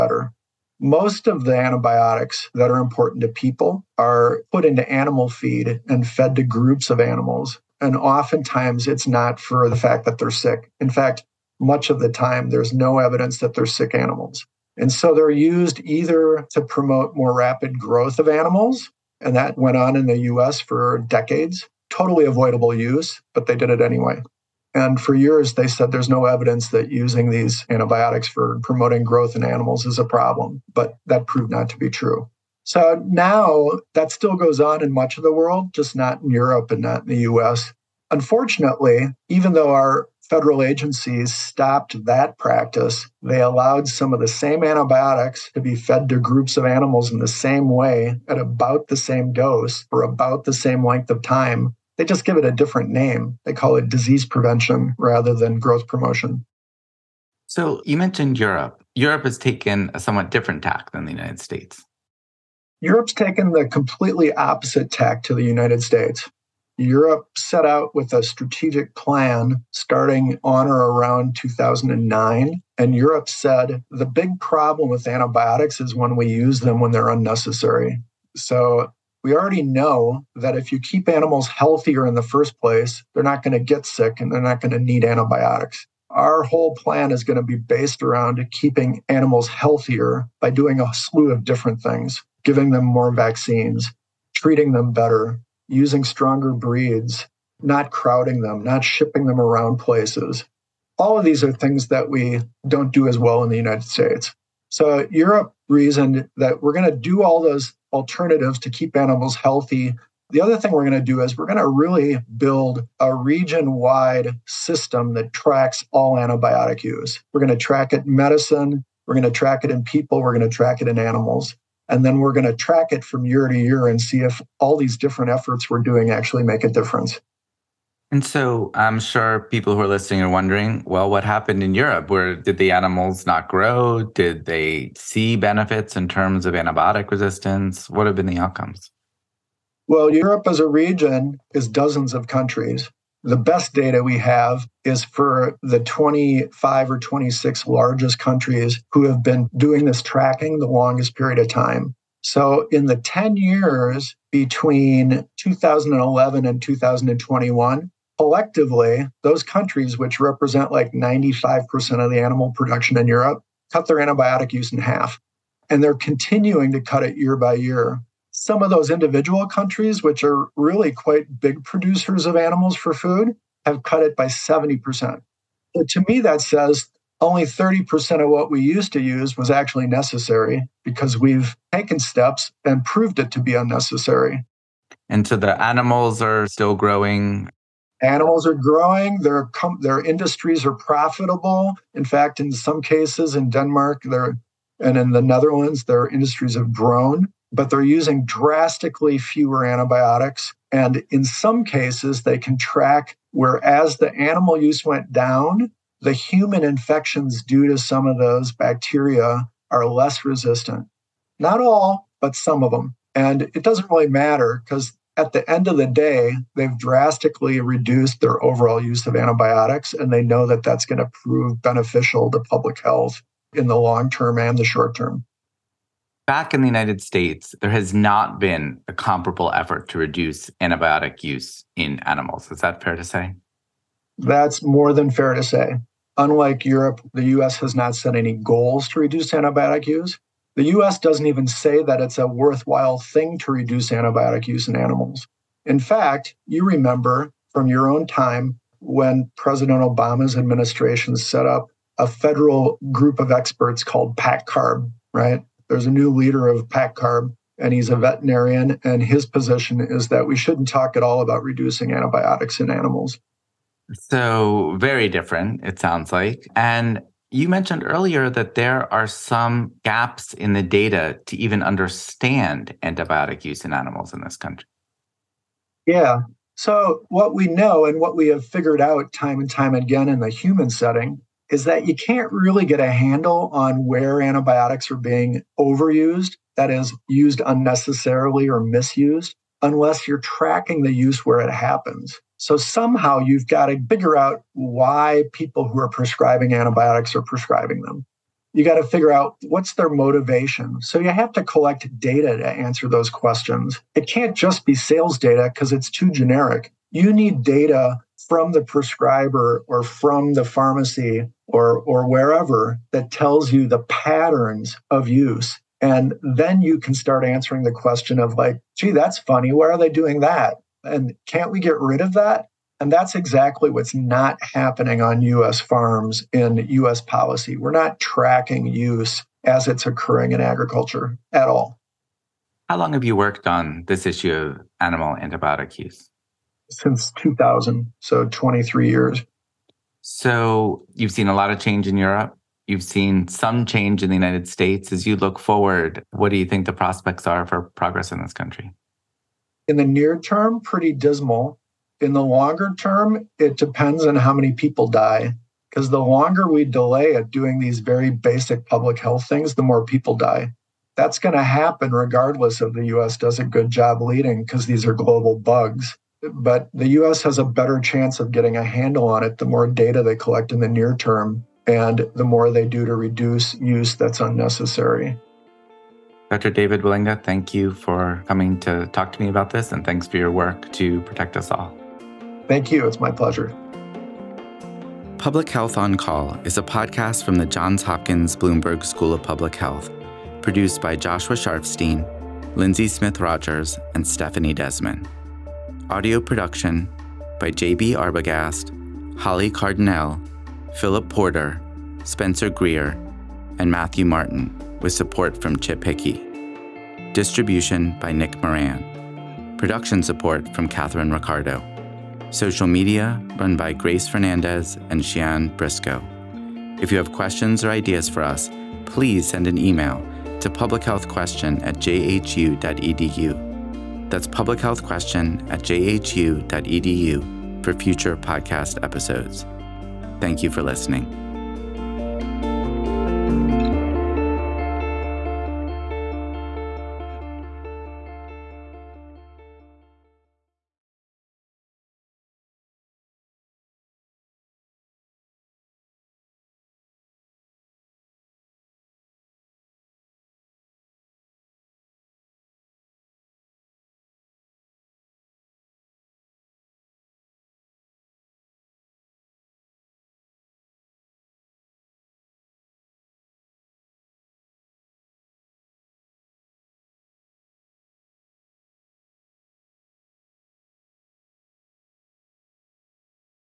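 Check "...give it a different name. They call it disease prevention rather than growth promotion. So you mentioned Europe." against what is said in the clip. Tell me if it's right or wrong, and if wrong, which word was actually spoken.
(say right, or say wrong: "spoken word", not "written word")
right.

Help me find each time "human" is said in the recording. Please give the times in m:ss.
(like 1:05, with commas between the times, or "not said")
3:26, 4:40.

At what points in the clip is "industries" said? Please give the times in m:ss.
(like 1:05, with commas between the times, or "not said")
3:10, 3:16.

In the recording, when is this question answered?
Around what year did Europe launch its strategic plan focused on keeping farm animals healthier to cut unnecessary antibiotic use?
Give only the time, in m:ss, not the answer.
1:11.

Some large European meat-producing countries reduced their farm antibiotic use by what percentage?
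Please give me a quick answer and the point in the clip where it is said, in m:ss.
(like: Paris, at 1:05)
70%, at 2:54.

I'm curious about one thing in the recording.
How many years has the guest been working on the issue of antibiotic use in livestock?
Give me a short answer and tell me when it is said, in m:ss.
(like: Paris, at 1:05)
23 years, at 5:38.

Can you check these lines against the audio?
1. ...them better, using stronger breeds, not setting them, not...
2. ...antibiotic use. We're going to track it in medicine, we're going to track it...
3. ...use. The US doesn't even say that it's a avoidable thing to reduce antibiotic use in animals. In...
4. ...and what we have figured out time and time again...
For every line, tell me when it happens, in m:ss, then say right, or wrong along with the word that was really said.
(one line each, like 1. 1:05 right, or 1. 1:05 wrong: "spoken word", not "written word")
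1. 1:34 wrong: "crowding", not "setting"
2. 1:56 right
3. 3:59 wrong: "worthwhile", not "avoidable"
4. 4:37 right.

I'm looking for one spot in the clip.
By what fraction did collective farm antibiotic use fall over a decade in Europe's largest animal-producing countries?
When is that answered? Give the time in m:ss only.
2:44.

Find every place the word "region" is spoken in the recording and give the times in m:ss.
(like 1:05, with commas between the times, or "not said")
1:53, 2:20.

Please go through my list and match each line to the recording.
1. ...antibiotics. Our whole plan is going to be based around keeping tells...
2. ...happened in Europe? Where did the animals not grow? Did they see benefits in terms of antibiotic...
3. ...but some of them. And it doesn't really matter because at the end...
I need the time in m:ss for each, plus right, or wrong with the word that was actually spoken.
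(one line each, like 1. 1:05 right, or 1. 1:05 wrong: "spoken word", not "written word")
1. 1:25 wrong: "animals", not "tells"
2. 2:11 right
3. 3:32 right.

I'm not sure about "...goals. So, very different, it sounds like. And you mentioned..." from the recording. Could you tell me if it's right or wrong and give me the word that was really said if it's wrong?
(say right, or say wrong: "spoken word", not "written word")
wrong: "animals", not "goals".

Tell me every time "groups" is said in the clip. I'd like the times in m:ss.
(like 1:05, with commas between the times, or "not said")
0:06, 0:46, 4:12.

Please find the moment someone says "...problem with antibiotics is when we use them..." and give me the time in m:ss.
1:14.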